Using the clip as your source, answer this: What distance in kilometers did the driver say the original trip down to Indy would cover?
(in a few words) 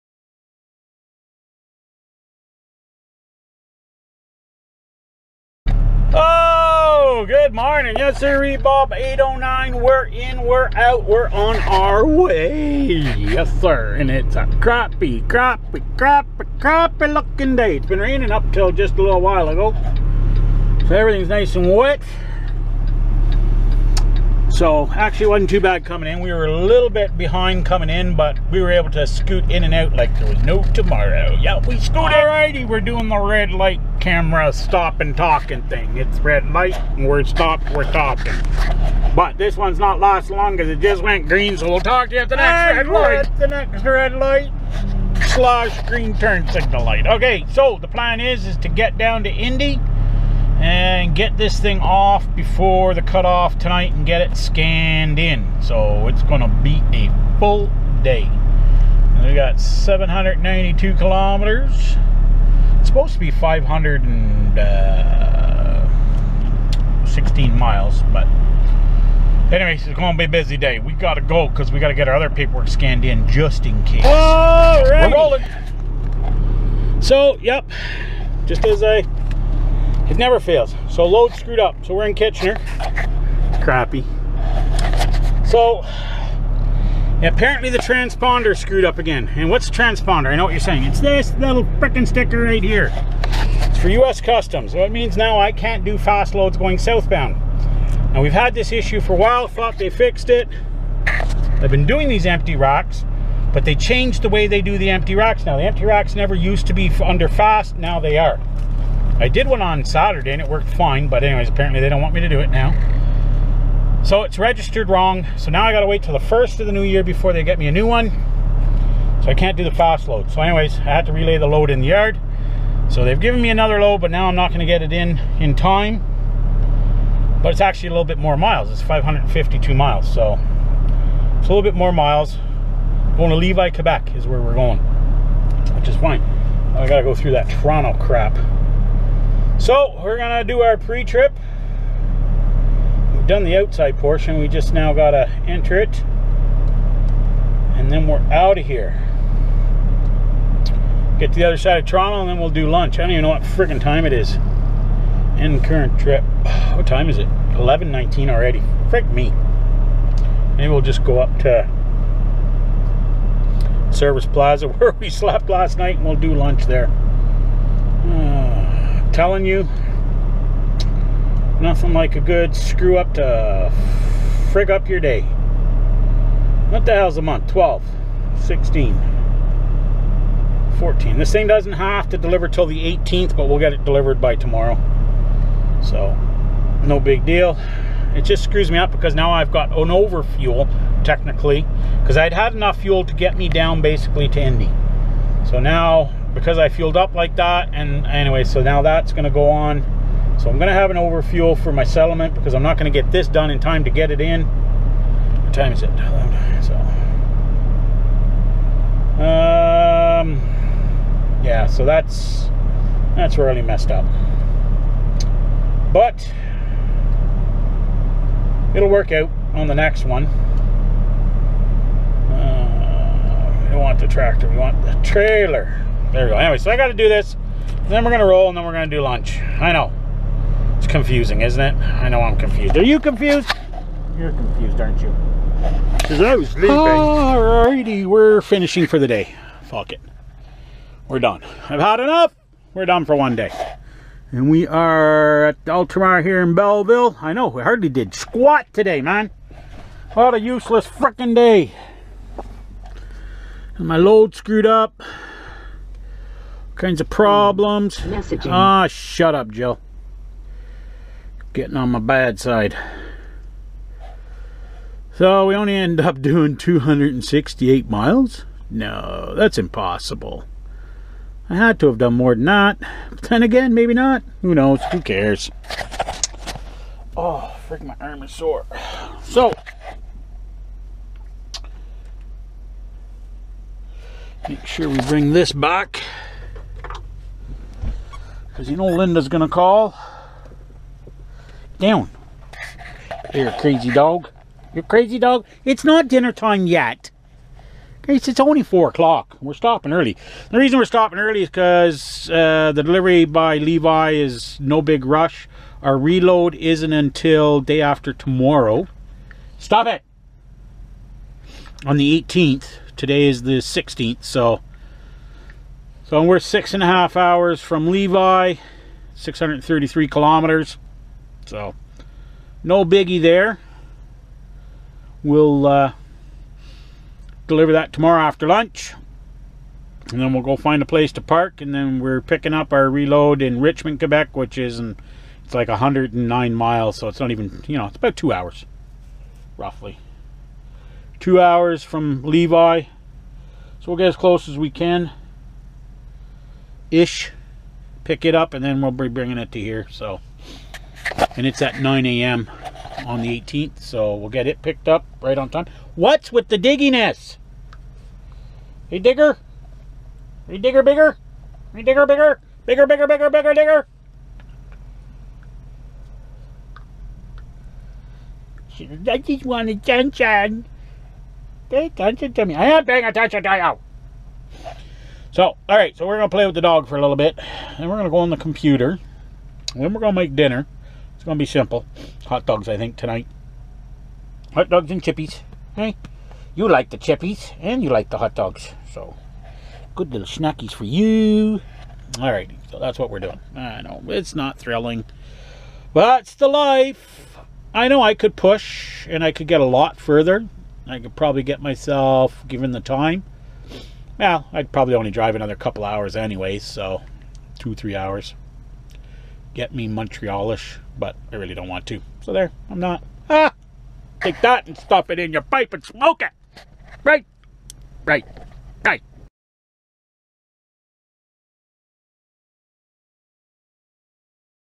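792.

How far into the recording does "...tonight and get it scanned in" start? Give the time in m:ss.
0:53.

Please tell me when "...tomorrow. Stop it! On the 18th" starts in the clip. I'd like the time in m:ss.
5:08.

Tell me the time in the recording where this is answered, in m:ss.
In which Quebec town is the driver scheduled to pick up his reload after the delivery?
5:33.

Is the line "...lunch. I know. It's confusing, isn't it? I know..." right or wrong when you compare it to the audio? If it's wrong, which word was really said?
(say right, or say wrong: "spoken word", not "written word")
right.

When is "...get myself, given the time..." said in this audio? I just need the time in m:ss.
6:41.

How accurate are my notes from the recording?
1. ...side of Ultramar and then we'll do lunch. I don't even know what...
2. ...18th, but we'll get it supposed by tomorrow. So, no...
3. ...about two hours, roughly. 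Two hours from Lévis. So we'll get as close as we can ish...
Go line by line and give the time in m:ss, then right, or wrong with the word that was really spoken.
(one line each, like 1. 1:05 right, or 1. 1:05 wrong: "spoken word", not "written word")
1. 2:31 wrong: "Toronto", not "Ultramar"
2. 3:02 wrong: "delivered", not "supposed"
3. 5:37 right.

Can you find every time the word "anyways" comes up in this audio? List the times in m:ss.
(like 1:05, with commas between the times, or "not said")
1:09, 1:51, 2:00, 3:18, 3:46, 6:46.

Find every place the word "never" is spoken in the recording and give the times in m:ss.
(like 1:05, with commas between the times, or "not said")
1:20, 1:46.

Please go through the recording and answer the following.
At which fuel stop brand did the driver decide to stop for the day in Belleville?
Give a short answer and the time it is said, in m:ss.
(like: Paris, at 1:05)
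Ultramar, at 4:05.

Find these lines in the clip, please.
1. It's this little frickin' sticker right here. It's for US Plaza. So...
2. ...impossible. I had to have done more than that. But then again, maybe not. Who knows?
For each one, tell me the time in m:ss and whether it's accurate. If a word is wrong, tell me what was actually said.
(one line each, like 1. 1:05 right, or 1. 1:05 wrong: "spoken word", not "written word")
1. 1:30 wrong: "Customs", not "Plaza"
2. 4:29 right.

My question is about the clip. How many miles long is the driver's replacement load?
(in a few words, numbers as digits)
552.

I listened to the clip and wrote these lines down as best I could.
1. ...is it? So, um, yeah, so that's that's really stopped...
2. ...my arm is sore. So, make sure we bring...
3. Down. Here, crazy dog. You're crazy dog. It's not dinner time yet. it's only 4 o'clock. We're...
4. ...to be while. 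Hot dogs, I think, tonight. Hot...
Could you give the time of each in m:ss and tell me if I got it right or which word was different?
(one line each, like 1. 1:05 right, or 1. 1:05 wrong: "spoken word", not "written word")
1. 3:25 wrong: "messed", not "stopped"
2. 4:37 right
3. 4:51 right
4. 6:21 wrong: "simple", not "while".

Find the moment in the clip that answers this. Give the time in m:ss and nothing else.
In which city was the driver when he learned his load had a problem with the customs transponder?
1:22.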